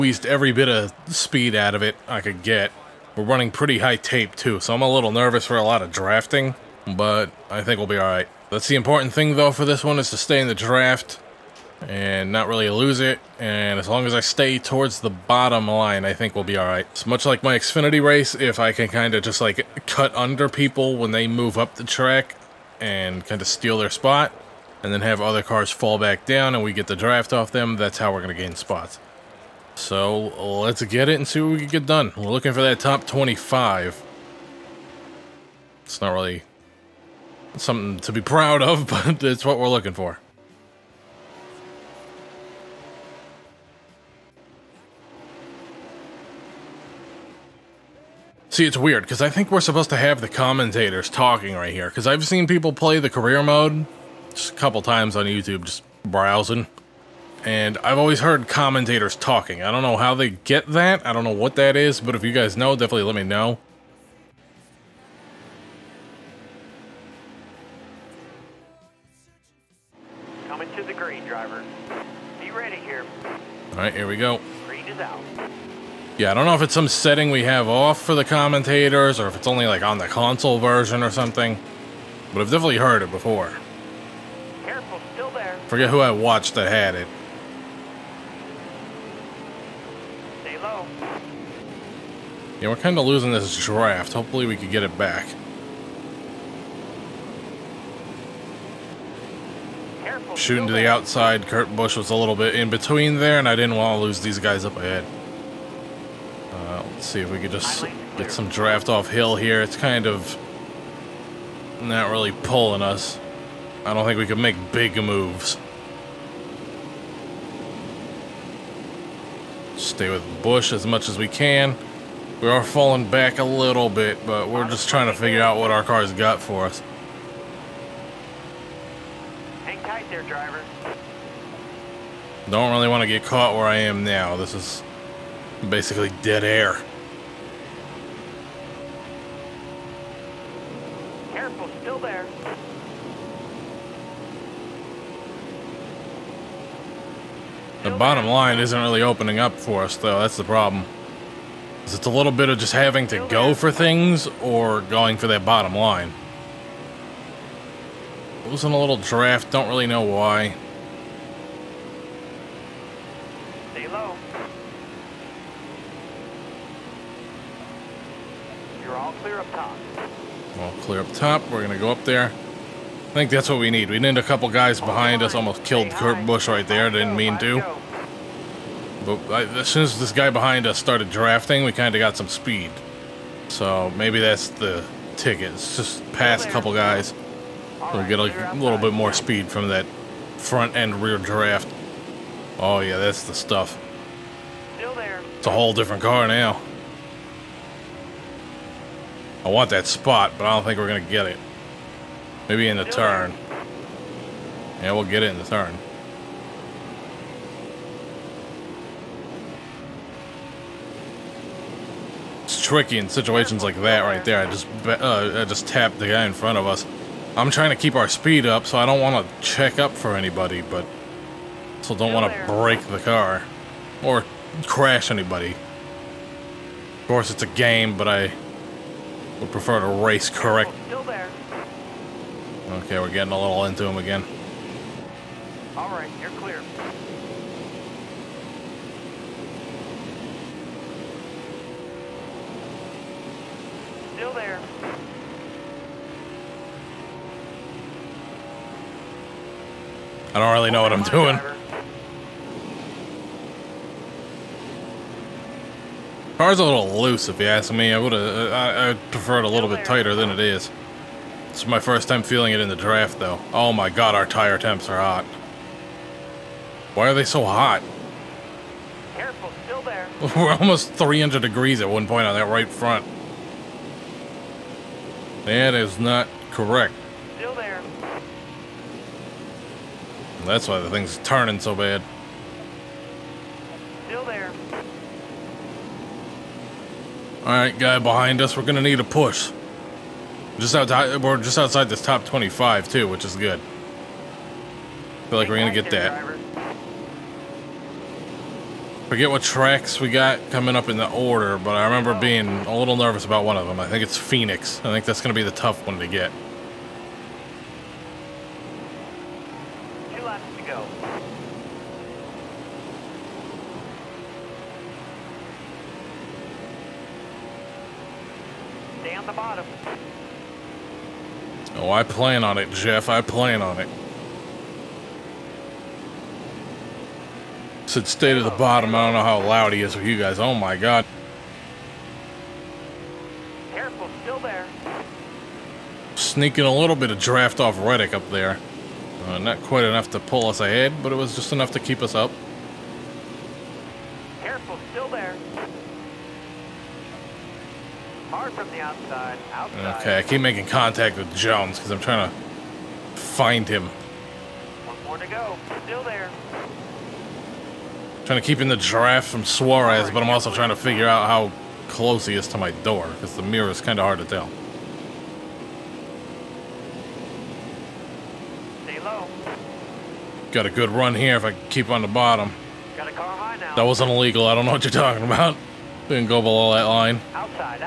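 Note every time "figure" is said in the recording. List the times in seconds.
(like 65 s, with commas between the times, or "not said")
125 s, 360 s.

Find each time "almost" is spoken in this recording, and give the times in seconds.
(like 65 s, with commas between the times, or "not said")
175 s, 270 s.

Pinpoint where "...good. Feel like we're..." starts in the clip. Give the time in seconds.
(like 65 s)
293 s.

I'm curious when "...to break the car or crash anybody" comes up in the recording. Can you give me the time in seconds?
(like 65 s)
222 s.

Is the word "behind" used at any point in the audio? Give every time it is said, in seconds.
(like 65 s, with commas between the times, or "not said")
174 s, 180 s, 287 s.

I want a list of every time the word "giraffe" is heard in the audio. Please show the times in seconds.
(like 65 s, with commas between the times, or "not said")
358 s.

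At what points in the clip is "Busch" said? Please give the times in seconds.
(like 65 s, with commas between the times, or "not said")
101 s, 120 s, 176 s.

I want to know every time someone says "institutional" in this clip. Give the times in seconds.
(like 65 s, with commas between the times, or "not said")
not said.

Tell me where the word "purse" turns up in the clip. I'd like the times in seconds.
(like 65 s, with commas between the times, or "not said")
not said.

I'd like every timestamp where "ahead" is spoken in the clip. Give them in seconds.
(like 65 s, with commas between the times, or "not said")
104 s, 340 s.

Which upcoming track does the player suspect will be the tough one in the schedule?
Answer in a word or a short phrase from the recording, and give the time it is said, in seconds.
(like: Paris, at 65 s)
Phoenix, at 304 s.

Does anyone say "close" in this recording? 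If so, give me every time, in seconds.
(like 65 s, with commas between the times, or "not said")
361 s.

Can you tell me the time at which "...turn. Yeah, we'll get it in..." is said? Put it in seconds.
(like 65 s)
202 s.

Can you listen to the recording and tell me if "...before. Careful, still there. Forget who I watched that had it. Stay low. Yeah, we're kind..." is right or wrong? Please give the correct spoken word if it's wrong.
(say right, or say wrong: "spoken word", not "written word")
right.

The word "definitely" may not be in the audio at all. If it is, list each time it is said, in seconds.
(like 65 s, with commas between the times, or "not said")
62 s, 82 s.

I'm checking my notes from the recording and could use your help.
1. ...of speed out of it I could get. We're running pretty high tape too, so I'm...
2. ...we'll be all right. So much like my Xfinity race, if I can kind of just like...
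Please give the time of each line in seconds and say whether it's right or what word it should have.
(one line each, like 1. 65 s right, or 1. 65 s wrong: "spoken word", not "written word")
1. 0 s right
2. 16 s right.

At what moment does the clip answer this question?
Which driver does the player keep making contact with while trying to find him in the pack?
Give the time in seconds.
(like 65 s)
351 s.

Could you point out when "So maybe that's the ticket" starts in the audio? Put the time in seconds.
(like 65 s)
183 s.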